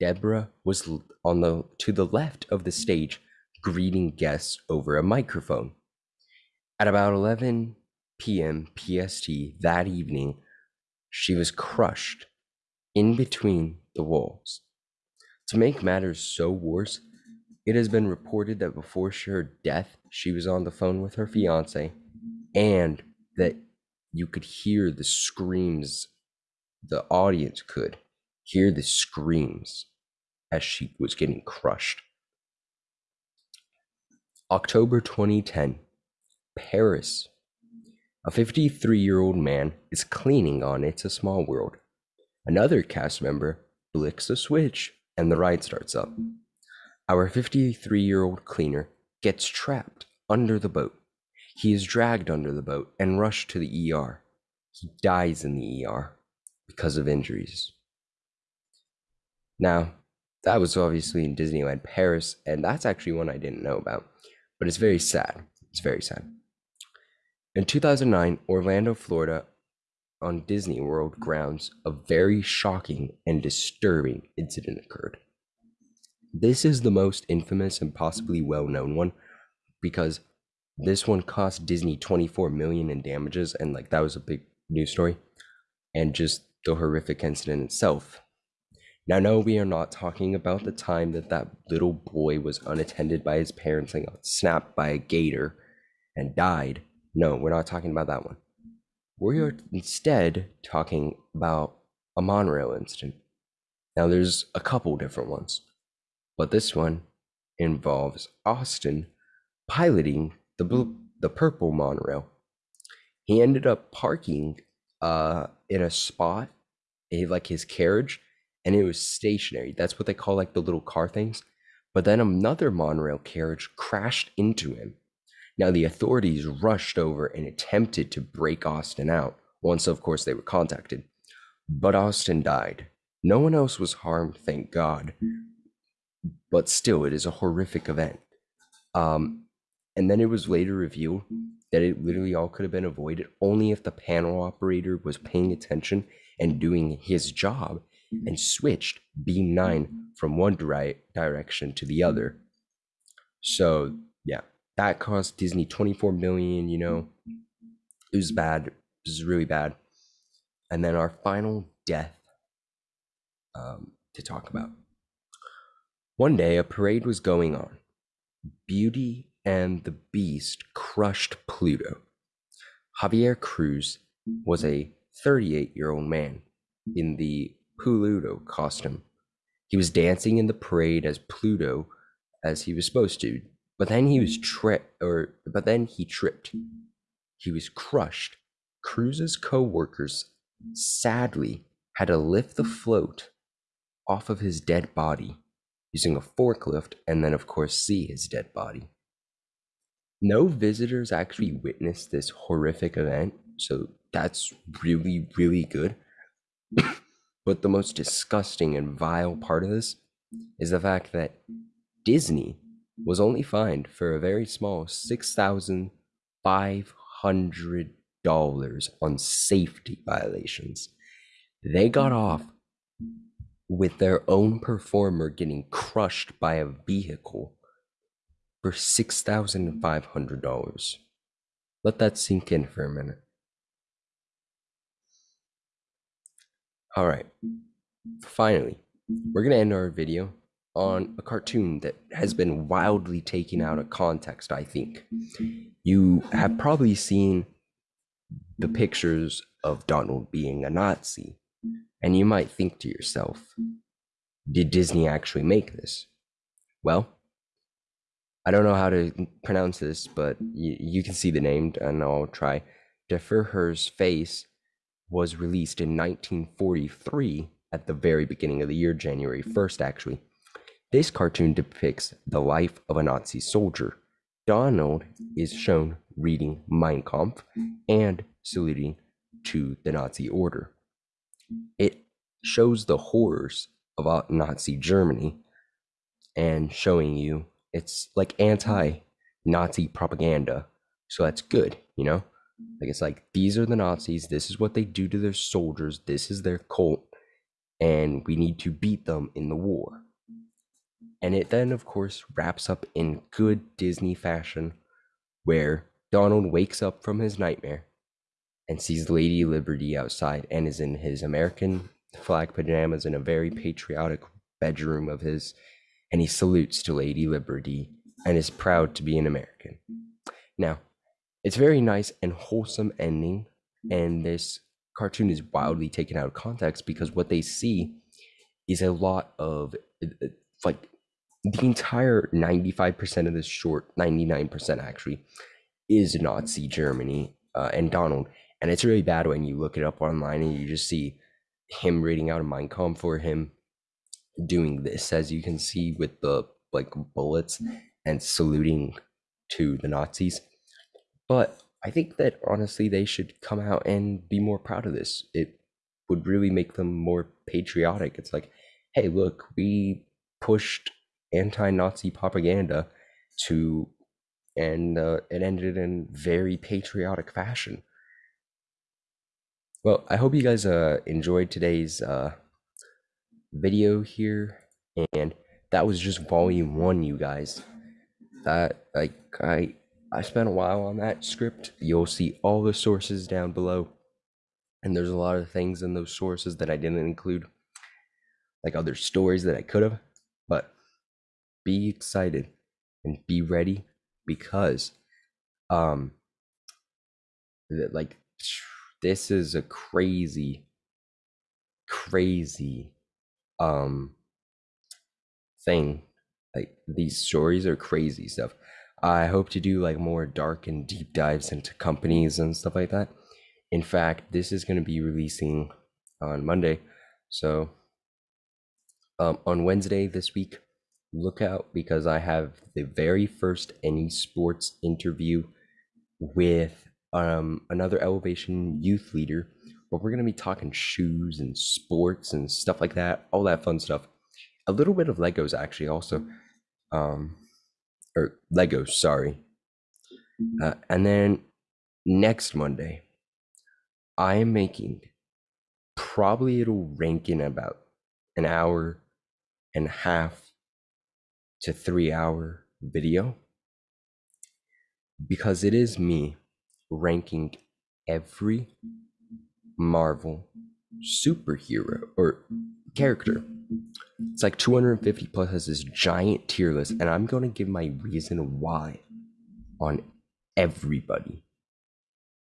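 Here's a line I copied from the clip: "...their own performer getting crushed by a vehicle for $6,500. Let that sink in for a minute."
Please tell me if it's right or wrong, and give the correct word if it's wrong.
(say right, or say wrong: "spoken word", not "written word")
right.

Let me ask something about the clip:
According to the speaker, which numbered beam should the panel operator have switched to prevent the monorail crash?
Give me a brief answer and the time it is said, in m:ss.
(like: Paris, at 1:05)
9, at 2:29.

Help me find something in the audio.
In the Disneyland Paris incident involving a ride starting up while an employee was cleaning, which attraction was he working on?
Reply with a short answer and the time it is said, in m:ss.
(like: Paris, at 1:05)
It's a Small World, at 0:40.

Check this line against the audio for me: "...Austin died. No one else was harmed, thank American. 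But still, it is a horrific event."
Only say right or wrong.
wrong.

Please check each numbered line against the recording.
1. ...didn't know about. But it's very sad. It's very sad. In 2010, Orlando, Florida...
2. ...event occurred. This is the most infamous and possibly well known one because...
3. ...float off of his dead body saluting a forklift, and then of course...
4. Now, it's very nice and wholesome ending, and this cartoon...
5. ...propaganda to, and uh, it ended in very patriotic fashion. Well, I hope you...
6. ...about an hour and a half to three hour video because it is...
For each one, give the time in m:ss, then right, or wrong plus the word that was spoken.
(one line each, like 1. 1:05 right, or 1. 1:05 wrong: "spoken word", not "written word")
1. 1:03 wrong: "2009", not "2010"
2. 1:14 wrong: "incident", not "event"
3. 3:12 wrong: "using", not "saluting"
4. 5:20 right
5. 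6:02 right
6. 7:27 right.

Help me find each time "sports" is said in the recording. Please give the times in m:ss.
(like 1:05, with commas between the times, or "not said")
7:04, 7:11.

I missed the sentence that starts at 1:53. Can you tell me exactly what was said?
He ended up parking uh, in a spot, in, like his carriage, and it was stationary.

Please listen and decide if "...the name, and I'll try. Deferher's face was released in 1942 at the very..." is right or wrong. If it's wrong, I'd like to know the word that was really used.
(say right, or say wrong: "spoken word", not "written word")
wrong: "1943", not "1942".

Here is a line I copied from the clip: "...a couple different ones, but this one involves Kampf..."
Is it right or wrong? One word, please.
wrong.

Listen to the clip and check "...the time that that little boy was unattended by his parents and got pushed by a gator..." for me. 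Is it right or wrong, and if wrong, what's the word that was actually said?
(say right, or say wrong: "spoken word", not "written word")
wrong: "snapped", not "pushed".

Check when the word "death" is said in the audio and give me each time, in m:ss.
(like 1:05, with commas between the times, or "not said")
0:19, 2:41.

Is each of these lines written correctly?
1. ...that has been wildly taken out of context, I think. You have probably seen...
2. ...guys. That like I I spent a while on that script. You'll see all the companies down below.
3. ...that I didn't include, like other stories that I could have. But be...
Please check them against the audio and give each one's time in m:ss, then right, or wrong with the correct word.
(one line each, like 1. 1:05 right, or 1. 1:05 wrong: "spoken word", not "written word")
1. 4:01 right
2. 6:17 wrong: "sources", not "companies"
3. 6:26 right.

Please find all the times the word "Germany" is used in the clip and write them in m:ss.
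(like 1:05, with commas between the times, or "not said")
4:44, 5:36.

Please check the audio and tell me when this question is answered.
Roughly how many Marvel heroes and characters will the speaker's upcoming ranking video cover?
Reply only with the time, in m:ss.
7:44.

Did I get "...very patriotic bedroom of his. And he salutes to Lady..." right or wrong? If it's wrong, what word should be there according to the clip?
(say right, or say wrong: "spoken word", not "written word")
right.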